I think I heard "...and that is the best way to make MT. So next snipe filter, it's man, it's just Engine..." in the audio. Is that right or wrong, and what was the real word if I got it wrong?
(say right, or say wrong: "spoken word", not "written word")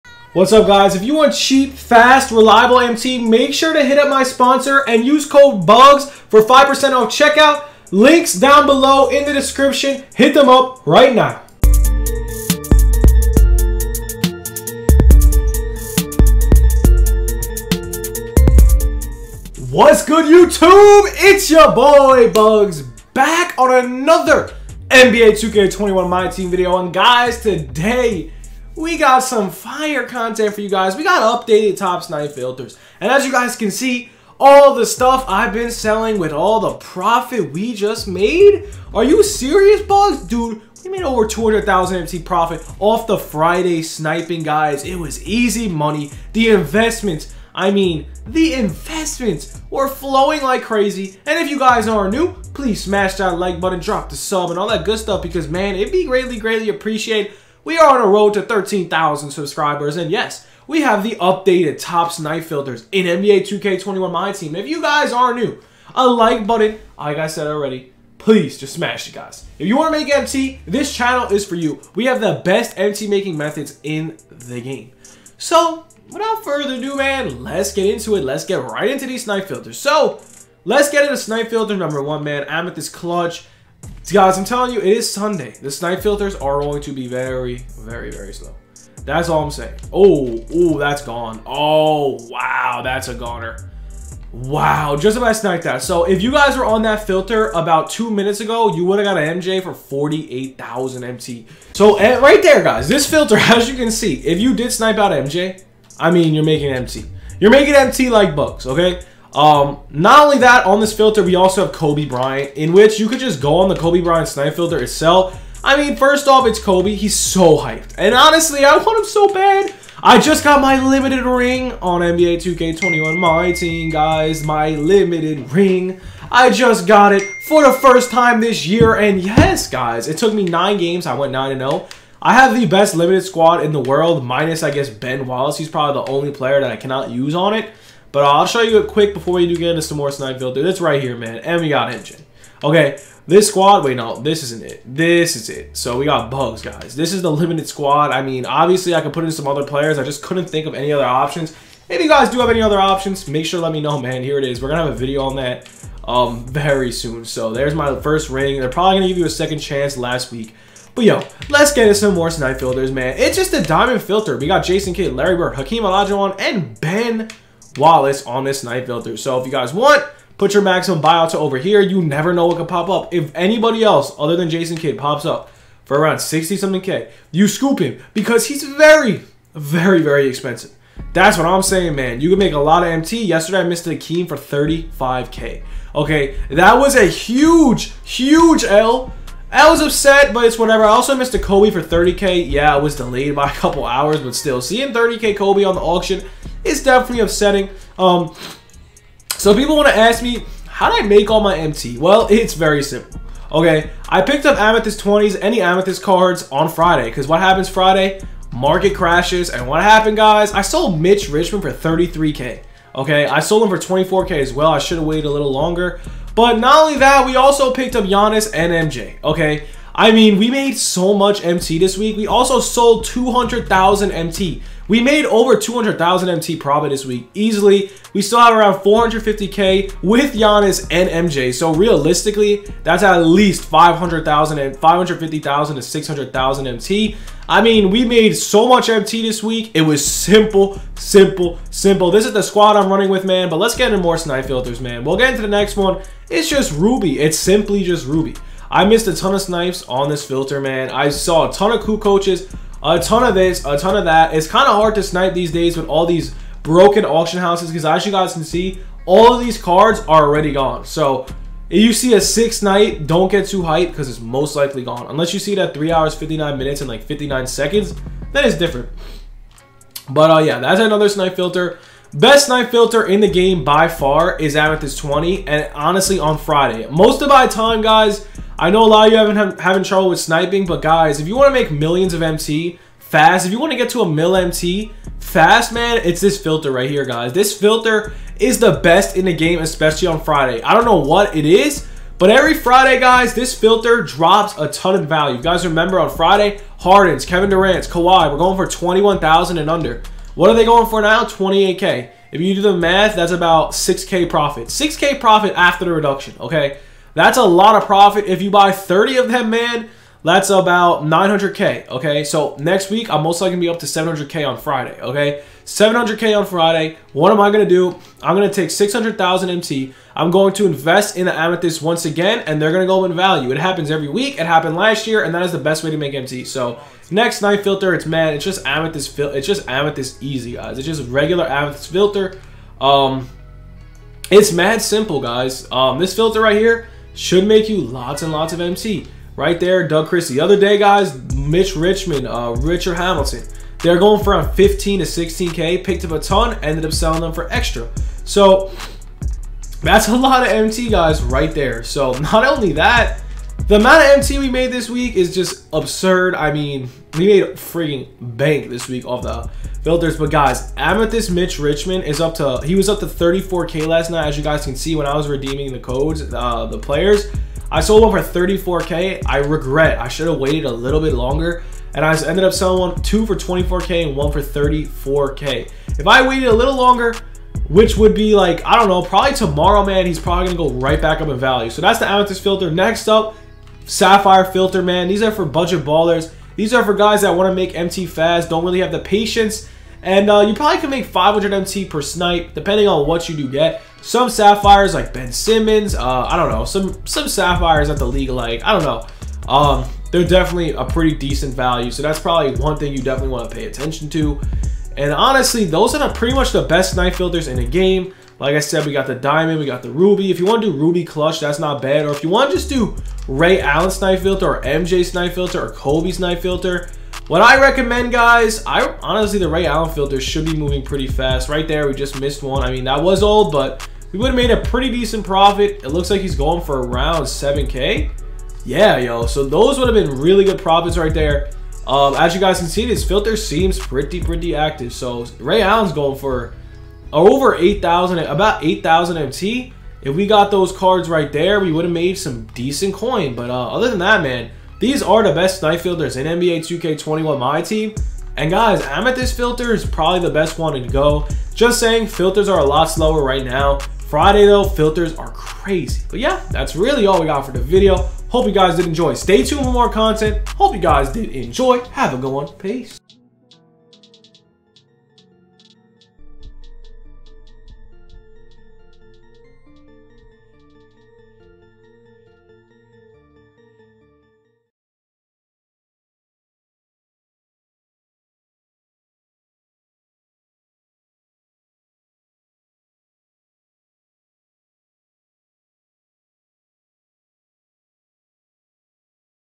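wrong: "Amethyst", not "Engine".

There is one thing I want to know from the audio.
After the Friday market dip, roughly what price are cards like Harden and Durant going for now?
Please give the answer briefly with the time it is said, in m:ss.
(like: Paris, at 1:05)
28K, at 5:01.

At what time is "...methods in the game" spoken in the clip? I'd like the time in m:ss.
1:13.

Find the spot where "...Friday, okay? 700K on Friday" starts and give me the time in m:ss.
5:14.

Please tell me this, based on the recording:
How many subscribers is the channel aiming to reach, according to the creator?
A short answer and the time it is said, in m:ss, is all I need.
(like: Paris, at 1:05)
13,000, at 0:58.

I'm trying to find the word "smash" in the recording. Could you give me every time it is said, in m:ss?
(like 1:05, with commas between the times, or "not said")
0:52, 1:08.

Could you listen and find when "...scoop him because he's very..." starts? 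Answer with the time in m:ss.
2:57.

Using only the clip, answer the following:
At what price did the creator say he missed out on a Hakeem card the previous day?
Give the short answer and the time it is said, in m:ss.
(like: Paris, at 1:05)
35K, at 3:04.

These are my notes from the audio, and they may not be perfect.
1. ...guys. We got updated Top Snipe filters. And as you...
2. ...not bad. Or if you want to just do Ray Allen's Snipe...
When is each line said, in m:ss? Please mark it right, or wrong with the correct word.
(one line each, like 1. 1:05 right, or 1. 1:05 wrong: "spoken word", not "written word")
1. 0:30 right
2. 6:51 right.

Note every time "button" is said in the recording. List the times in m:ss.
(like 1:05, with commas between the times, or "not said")
0:53, 1:06.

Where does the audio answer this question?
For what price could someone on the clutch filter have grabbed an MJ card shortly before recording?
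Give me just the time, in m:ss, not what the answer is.
1:39.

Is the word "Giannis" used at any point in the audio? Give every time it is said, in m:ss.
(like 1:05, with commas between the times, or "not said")
3:38, 3:50.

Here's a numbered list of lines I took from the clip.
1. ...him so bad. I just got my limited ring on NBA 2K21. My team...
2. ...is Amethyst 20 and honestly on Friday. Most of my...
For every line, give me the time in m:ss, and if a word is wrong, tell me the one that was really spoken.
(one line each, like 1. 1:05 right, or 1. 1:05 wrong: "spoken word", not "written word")
1. 1:58 right
2. 4:34 right.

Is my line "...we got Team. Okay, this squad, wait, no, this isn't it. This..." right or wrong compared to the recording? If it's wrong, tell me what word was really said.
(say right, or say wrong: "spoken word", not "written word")
wrong: "Engine", not "Team".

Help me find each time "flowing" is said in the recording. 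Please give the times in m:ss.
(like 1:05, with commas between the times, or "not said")
0:49.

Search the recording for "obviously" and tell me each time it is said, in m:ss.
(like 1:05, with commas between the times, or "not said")
2:28.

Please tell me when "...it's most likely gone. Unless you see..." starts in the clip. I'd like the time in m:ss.
4:24.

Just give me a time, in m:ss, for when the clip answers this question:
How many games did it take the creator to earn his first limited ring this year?
2:10.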